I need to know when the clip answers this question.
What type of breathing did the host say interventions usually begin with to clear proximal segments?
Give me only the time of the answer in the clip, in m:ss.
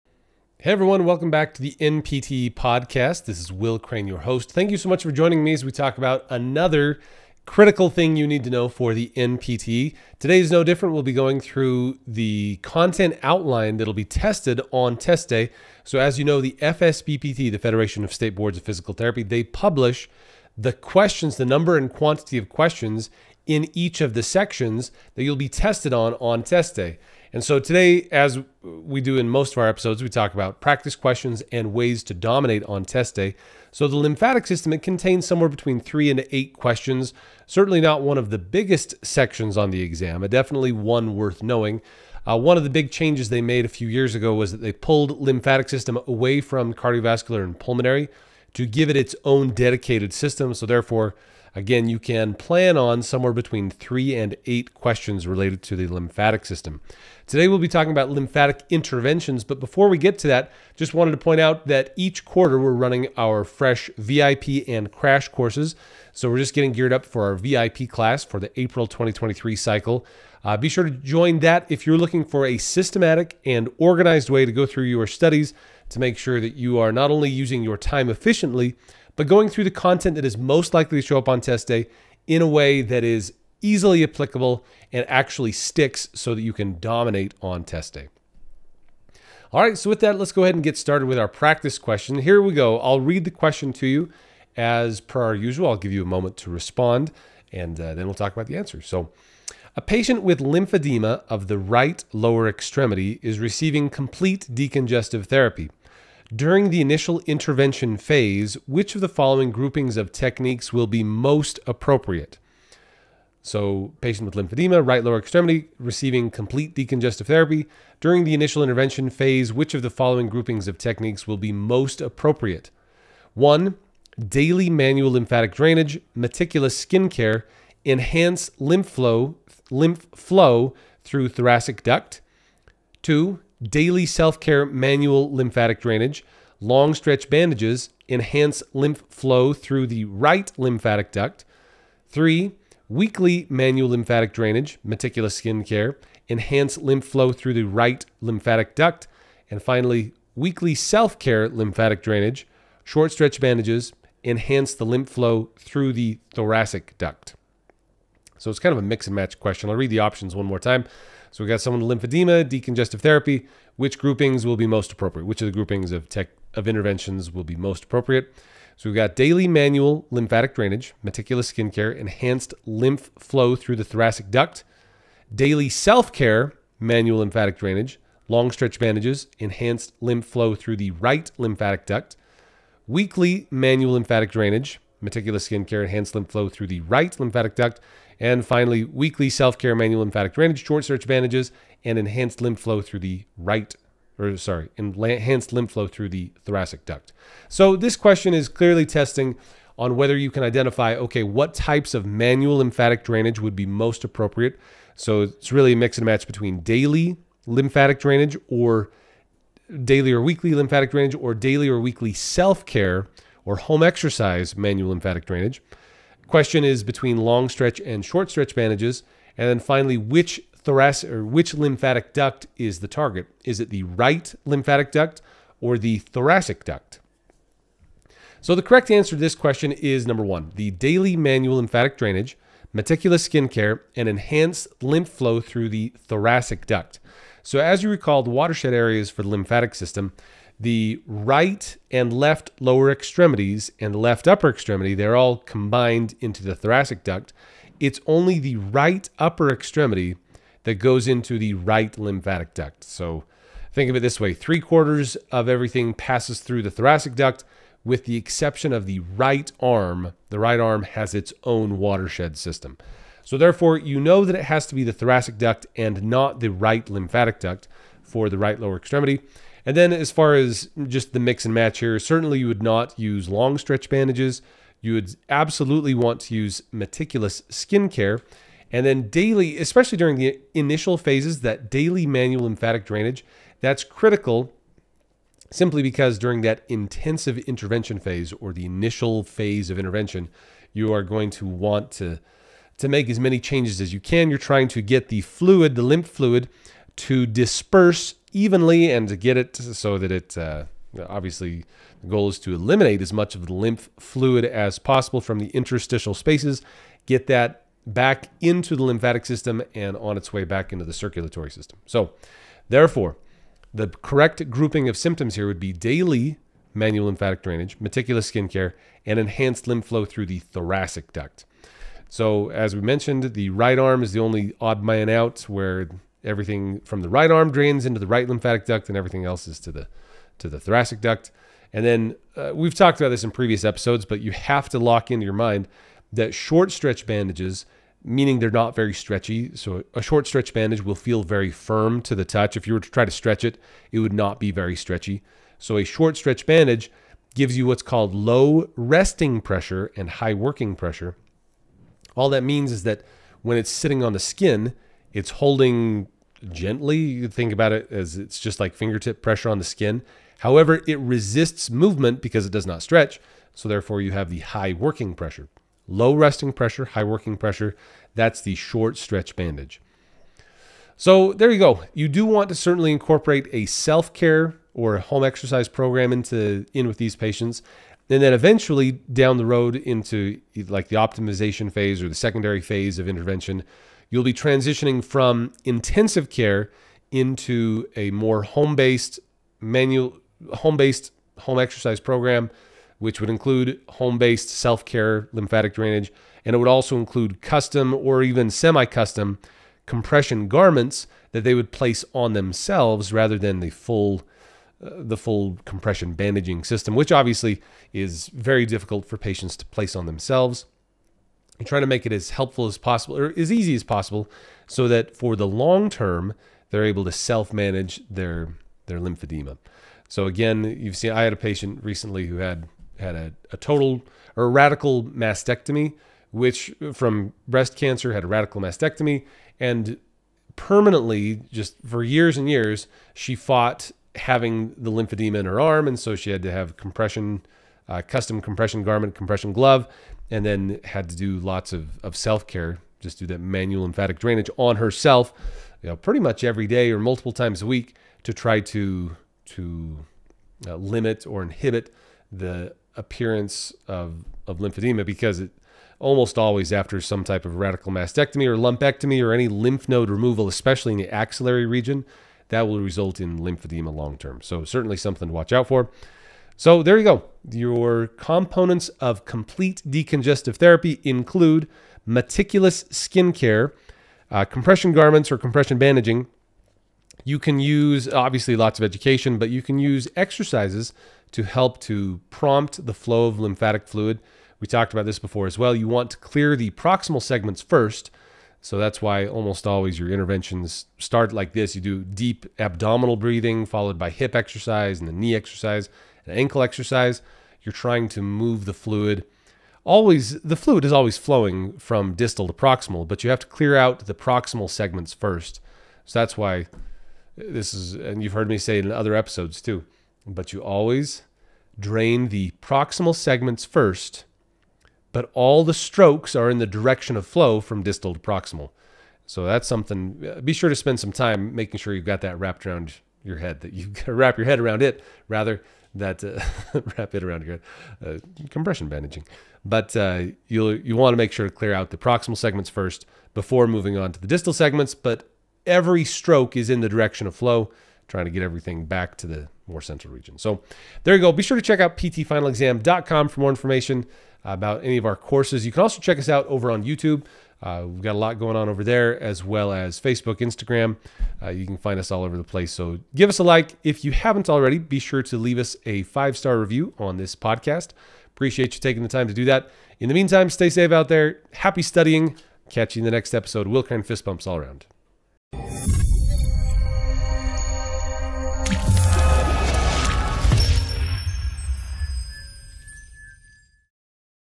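8:12.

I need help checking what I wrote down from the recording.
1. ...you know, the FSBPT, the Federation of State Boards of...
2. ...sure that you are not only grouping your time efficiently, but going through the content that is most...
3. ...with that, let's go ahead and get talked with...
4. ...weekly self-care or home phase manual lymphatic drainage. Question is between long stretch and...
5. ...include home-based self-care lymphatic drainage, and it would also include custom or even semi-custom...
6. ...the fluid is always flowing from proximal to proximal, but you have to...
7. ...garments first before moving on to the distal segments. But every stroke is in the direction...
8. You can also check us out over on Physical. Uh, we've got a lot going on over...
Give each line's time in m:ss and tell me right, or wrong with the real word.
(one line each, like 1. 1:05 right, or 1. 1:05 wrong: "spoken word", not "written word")
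1. 0:16 right
2. 1:16 wrong: "using", not "grouping"
3. 1:29 wrong: "started", not "talked"
4. 3:31 wrong: "exercise", not "phase"
5. 6:33 right
6. 8:20 wrong: "distal", not "proximal"
7. 8:52 wrong: "segments", not "garments"
8. 9:05 wrong: "YouTube", not "Physical".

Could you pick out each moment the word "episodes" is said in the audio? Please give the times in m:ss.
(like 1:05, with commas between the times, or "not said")
0:29, 5:33, 8:29, 9:23.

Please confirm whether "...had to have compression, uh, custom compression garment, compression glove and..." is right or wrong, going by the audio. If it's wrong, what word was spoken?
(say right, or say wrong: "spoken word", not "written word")
right.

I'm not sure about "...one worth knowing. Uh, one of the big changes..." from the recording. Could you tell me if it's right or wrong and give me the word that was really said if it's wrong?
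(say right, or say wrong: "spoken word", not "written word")
right.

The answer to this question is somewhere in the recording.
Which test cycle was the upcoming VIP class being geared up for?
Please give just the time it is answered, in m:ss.
1:08.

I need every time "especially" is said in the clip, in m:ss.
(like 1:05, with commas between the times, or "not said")
4:39, 7:40.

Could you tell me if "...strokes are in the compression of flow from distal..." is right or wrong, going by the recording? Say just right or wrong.
wrong.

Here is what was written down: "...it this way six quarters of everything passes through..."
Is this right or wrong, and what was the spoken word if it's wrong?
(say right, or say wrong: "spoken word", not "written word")
wrong: "three", not "six".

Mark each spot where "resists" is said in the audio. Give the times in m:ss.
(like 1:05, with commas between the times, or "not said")
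6:00.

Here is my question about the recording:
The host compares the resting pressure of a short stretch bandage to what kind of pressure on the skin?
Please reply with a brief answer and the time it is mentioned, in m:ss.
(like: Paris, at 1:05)
fingertip pressure, at 5:58.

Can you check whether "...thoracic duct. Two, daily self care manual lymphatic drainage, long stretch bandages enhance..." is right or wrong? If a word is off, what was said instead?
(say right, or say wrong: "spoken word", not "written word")
right.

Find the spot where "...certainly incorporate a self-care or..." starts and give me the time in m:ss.
6:12.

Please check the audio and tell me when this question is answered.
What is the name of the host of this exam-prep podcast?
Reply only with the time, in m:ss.
0:03.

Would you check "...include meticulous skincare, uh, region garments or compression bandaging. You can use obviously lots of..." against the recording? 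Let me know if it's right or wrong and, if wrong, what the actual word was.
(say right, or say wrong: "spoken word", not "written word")
wrong: "compression", not "region".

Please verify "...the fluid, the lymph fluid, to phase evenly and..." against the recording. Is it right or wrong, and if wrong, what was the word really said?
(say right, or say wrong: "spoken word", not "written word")
wrong: "disperse", not "phase".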